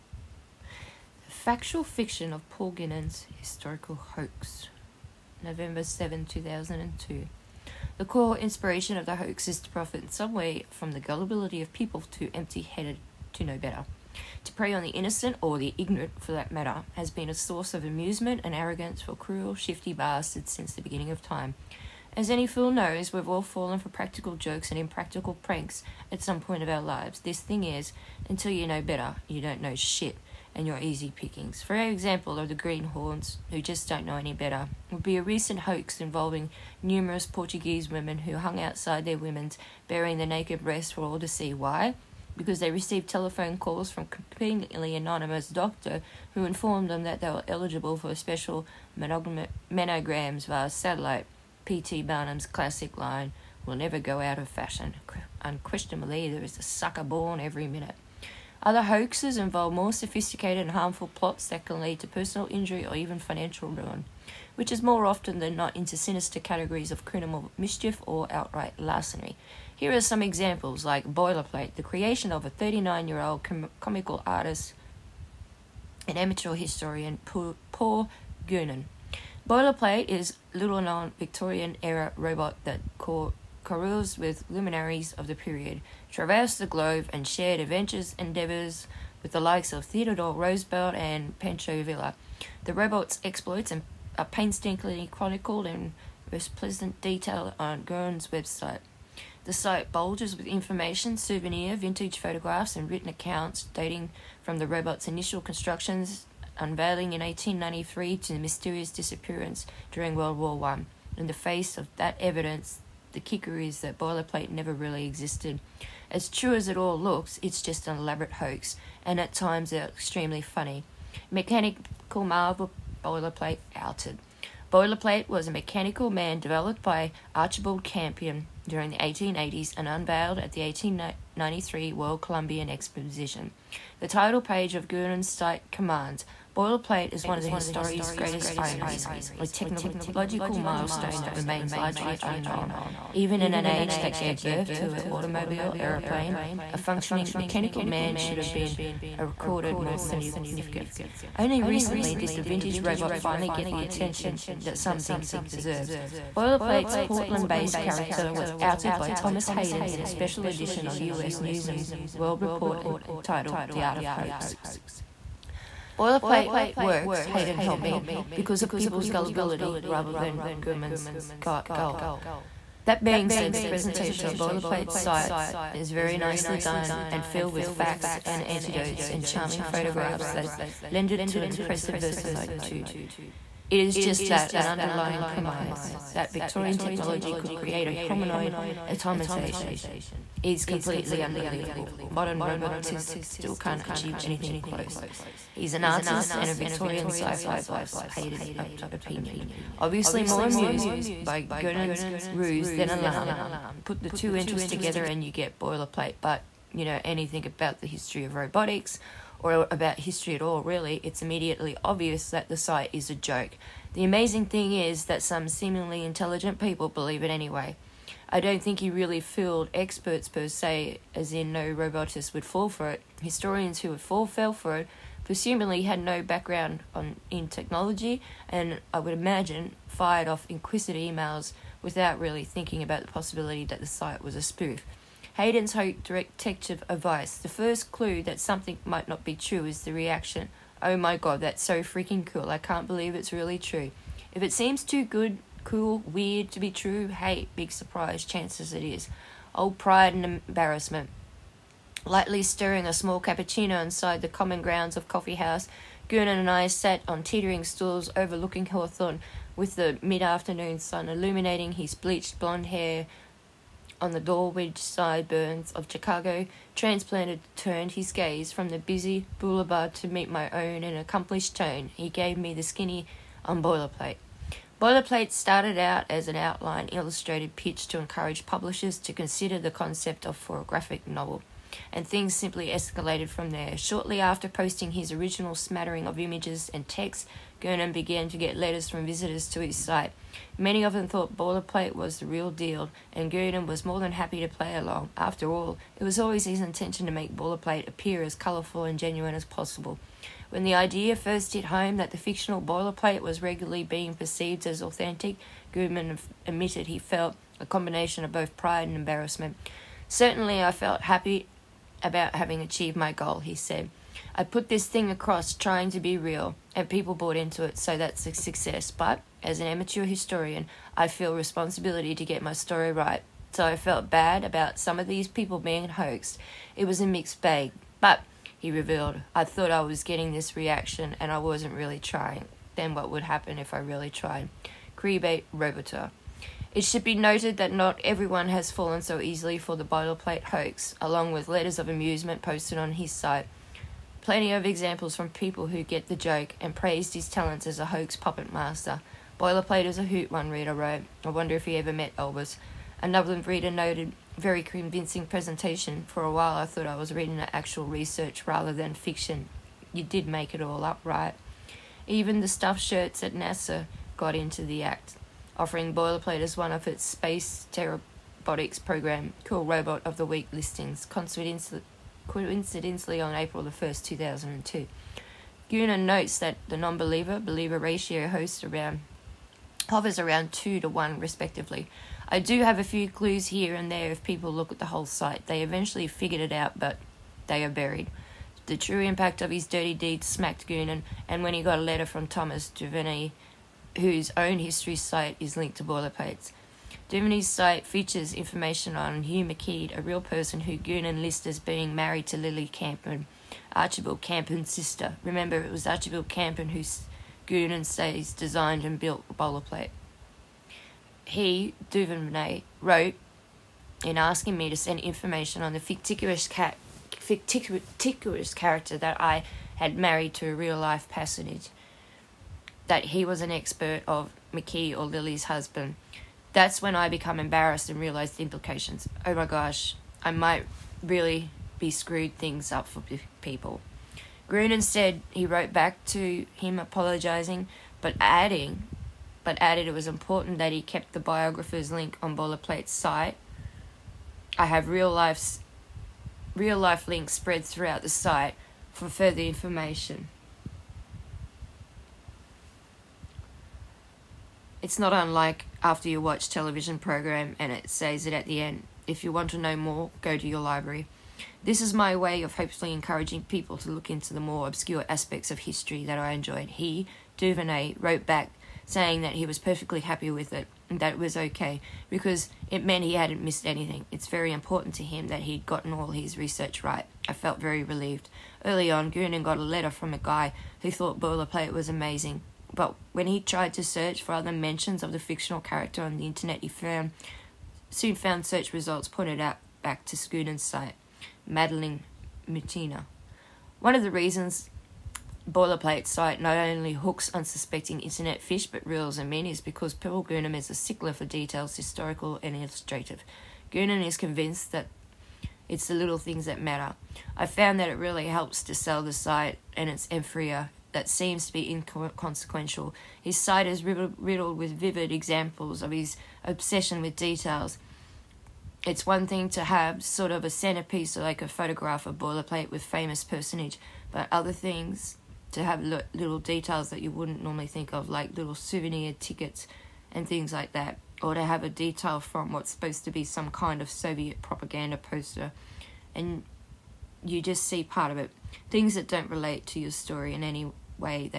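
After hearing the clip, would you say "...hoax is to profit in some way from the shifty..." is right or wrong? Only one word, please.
wrong.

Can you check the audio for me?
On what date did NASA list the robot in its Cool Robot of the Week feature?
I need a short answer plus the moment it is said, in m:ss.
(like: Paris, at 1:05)
April 1, 2002, at 6:13.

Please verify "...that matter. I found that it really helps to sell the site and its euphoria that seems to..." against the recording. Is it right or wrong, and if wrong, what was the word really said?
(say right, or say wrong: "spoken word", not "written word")
right.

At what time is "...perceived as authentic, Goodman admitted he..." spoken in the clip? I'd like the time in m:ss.
5:04.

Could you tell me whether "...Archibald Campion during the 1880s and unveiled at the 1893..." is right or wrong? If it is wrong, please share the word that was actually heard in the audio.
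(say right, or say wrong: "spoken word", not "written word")
right.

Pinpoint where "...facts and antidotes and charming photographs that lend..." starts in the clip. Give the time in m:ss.
2:57.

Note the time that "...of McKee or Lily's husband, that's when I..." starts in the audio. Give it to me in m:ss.
7:04.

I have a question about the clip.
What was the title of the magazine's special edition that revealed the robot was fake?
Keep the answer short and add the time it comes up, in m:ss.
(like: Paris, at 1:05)
The Art of Hoax, at 2:43.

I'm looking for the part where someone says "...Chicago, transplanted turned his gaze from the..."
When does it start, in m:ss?
4:25.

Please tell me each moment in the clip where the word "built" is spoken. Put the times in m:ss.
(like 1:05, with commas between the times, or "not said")
6:48.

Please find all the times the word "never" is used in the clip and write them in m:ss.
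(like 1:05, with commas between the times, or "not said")
0:53, 1:54.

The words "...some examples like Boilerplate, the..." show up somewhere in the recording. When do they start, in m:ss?
1:10.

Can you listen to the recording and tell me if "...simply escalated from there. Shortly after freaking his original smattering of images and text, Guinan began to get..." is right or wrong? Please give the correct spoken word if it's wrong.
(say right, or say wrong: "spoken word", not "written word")
wrong: "posting", not "freaking".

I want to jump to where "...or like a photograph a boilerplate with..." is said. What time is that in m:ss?
8:41.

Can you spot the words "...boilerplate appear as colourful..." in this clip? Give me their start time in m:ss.
4:57.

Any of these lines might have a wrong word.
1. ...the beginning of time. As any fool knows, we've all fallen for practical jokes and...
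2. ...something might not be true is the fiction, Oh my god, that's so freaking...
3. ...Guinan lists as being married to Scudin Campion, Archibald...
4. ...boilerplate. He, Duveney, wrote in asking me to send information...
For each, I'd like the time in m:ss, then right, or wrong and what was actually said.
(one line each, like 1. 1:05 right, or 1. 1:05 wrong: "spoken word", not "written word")
1. 0:20 right
2. 3:58 wrong: "reaction", not "fiction"
3. 6:40 wrong: "Lily", not "Scudin"
4. 6:49 right.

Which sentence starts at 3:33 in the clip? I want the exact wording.
The amazing thing is that some seemingly intelligent people believe it anyway.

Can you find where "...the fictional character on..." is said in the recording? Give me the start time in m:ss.
8:05.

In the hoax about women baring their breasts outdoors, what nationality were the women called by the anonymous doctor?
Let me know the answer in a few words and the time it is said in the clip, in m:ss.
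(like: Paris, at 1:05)
Portuguese, at 0:37.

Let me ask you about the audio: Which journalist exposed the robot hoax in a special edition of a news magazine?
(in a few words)
Thomas Hayden.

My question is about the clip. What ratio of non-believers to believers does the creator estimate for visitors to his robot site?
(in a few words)
2 to 1.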